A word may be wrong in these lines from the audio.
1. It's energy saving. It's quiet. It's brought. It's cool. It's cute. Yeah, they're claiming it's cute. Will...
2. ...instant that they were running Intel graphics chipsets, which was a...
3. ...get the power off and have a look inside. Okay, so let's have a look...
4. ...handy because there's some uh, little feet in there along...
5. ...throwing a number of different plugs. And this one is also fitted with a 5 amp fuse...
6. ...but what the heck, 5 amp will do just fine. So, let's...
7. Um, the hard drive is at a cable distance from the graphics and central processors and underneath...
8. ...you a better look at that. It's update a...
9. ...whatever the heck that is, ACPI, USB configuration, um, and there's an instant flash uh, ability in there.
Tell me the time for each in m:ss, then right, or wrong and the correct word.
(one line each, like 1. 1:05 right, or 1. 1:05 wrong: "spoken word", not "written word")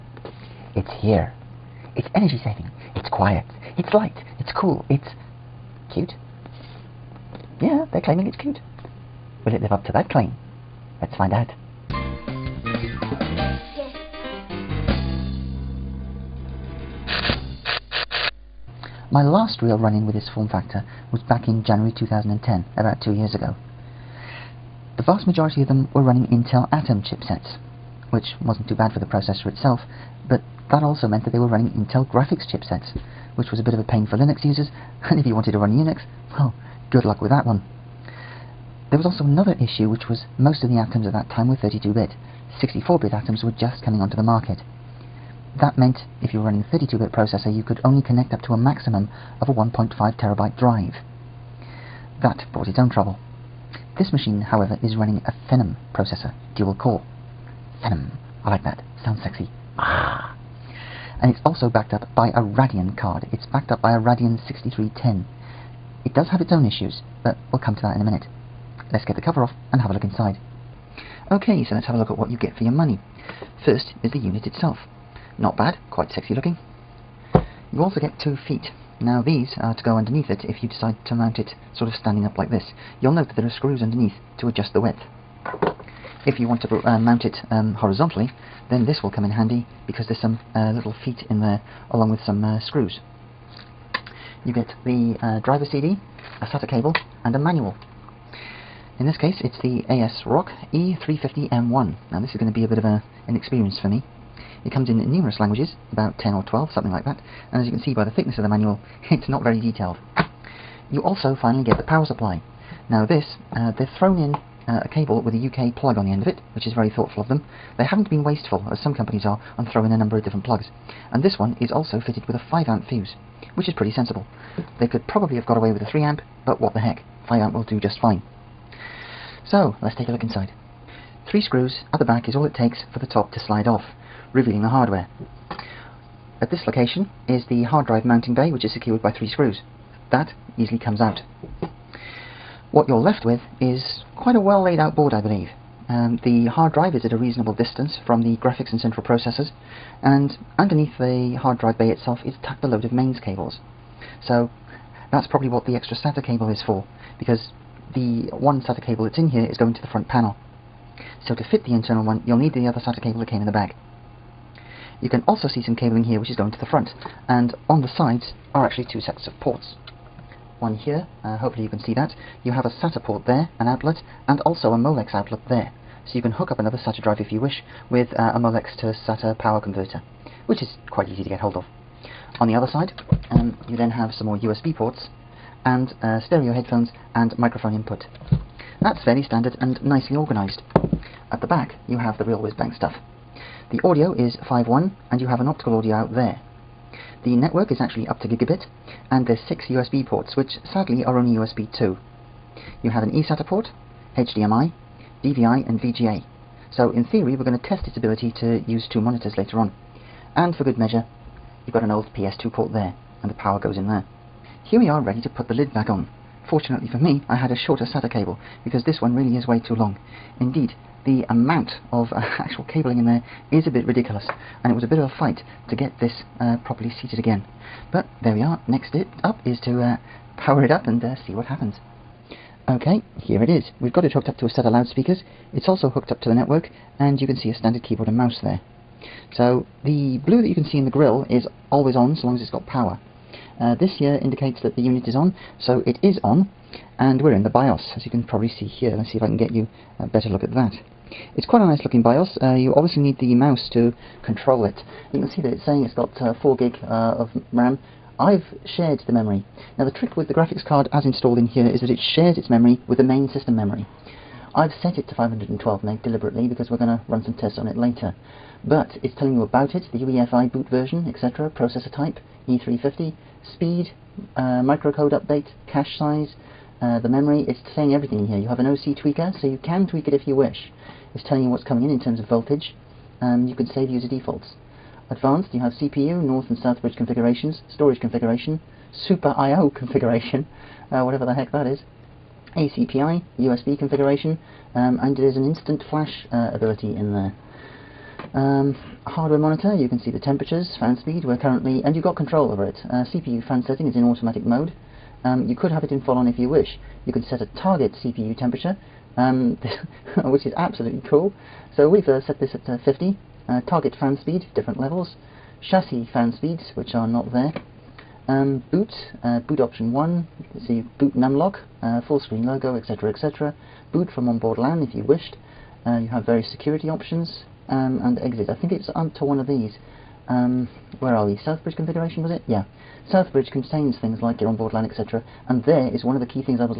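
1. 0:01 wrong: "light", not "brought"
2. 0:31 wrong: "meant", not "instant"
3. 1:09 wrong: "cover", not "power"
4. 1:29 right
5. 1:59 right
6. 2:06 right
7. 2:25 wrong: "reasonable", not "cable"
8. 4:09 wrong: "quite", not "update"
9. 4:51 right.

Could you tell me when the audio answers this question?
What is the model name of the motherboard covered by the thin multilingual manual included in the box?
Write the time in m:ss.
1:39.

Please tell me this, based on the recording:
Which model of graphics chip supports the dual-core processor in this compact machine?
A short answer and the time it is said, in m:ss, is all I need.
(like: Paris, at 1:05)
Radeon 6310, at 1:03.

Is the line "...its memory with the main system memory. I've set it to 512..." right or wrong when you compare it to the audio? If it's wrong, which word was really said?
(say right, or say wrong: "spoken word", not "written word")
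right.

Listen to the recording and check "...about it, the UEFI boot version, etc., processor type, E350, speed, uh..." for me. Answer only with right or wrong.
right.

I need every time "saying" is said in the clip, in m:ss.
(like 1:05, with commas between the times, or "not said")
4:15, 4:37.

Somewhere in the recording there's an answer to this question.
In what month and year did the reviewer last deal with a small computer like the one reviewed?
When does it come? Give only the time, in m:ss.
0:21.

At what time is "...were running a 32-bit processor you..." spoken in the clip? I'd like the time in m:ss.
0:46.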